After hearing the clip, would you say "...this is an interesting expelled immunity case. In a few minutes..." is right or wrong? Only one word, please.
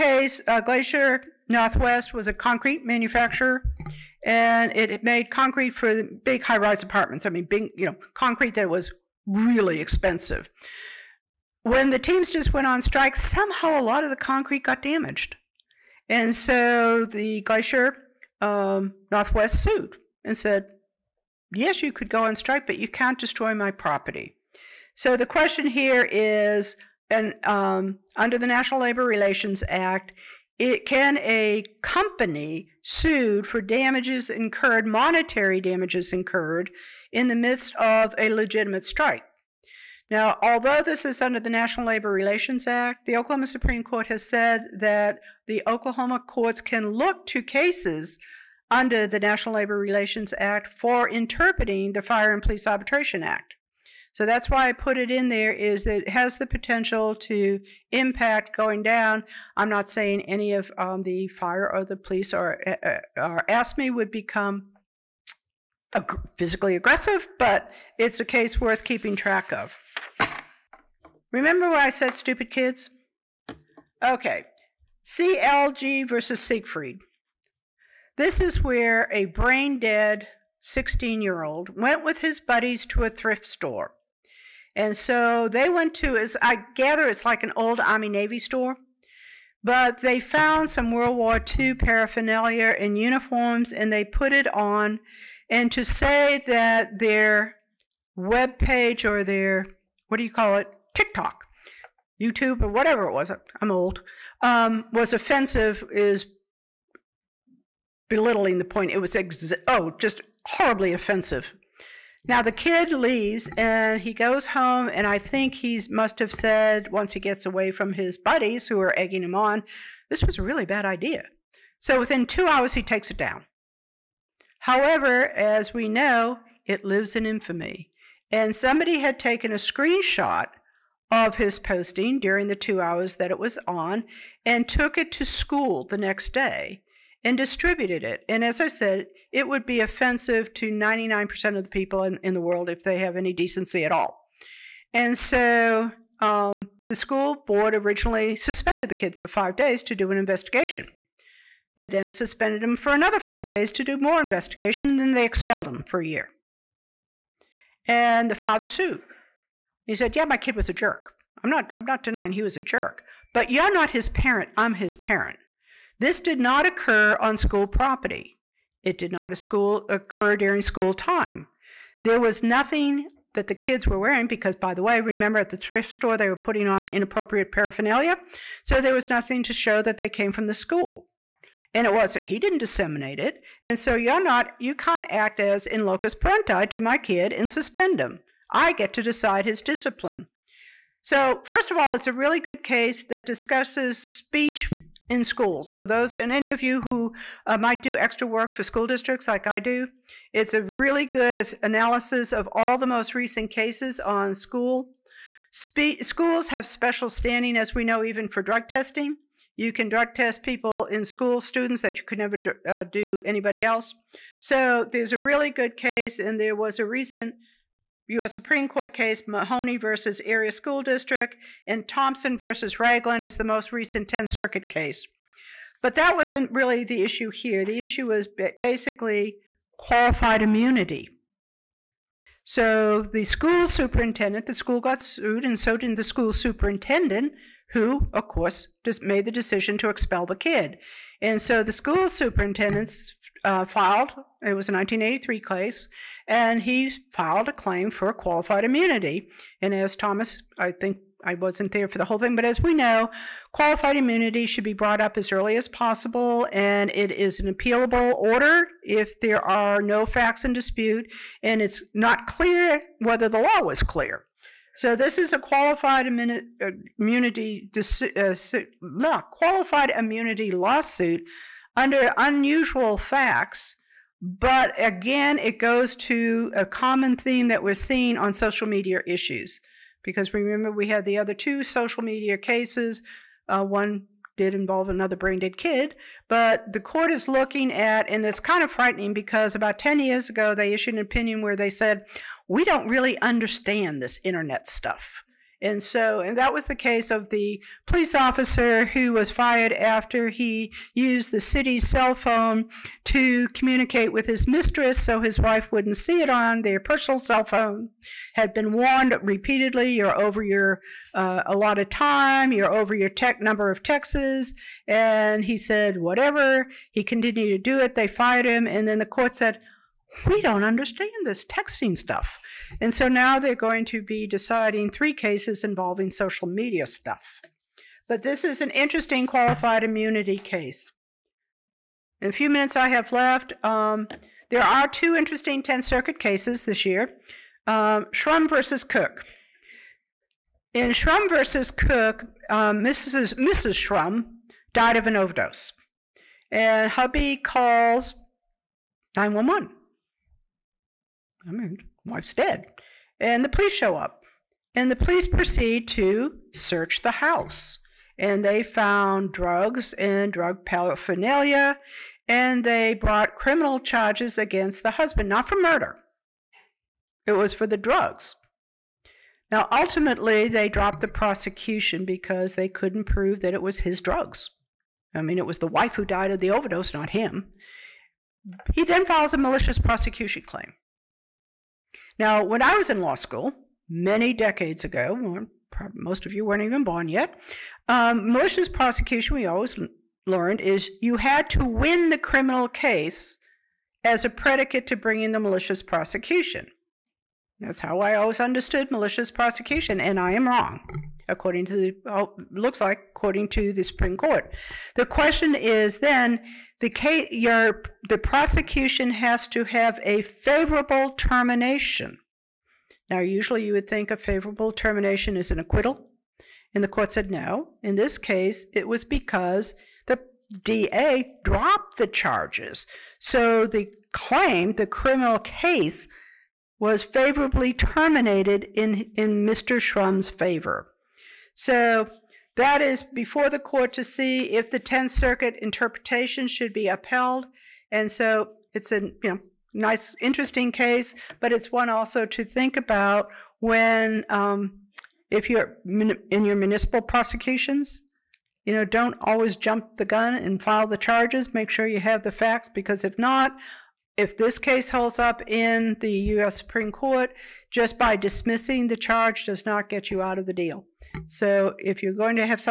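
wrong.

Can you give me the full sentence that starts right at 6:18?
He then files a malicious prosecution claim.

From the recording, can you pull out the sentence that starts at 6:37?
That's how I always understood malicious prosecution, and I am wrong, according to the, oh, looks like, according to the Supreme Court.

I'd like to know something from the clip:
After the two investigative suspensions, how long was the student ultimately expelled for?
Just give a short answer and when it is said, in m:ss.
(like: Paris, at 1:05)
1 year, at 2:36.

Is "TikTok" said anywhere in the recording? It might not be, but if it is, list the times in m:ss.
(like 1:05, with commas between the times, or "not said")
1:40.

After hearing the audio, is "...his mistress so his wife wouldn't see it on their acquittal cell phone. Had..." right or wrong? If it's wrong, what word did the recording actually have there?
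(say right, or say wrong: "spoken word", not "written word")
wrong: "personal", not "acquittal".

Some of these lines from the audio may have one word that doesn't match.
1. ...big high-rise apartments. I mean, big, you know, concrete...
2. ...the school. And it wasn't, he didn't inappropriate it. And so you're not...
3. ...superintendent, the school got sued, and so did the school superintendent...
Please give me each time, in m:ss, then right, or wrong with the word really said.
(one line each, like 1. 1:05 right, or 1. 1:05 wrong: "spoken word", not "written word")
1. 0:06 right
2. 3:00 wrong: "disseminate", not "inappropriate"
3. 3:53 right.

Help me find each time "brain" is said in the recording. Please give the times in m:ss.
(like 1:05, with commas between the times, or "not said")
1:19, 4:45.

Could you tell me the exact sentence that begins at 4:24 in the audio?
So this is a qualified immunity, uh, qualified immunity lawsuit under unusual facts.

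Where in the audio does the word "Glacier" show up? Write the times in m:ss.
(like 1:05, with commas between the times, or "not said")
0:00, 0:17.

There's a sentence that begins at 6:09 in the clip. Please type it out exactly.
Now, ultimately, they dropped the prosecution because they couldn't prove that it was his drugs.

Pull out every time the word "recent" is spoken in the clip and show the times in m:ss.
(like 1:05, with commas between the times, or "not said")
3:23, 3:36, 3:43.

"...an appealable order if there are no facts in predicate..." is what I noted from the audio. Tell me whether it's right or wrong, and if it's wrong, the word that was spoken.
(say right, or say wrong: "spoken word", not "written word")
wrong: "dispute", not "predicate".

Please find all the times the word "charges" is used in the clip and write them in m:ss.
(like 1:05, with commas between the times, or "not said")
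6:03, 7:02, 7:30, 7:38.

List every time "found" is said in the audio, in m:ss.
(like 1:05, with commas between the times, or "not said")
1:30, 5:58.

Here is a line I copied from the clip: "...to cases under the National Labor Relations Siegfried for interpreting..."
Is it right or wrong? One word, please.
wrong.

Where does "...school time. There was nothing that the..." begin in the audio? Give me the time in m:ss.
2:50.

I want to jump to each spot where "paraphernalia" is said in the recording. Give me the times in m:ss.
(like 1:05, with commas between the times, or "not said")
1:31, 2:57, 6:00.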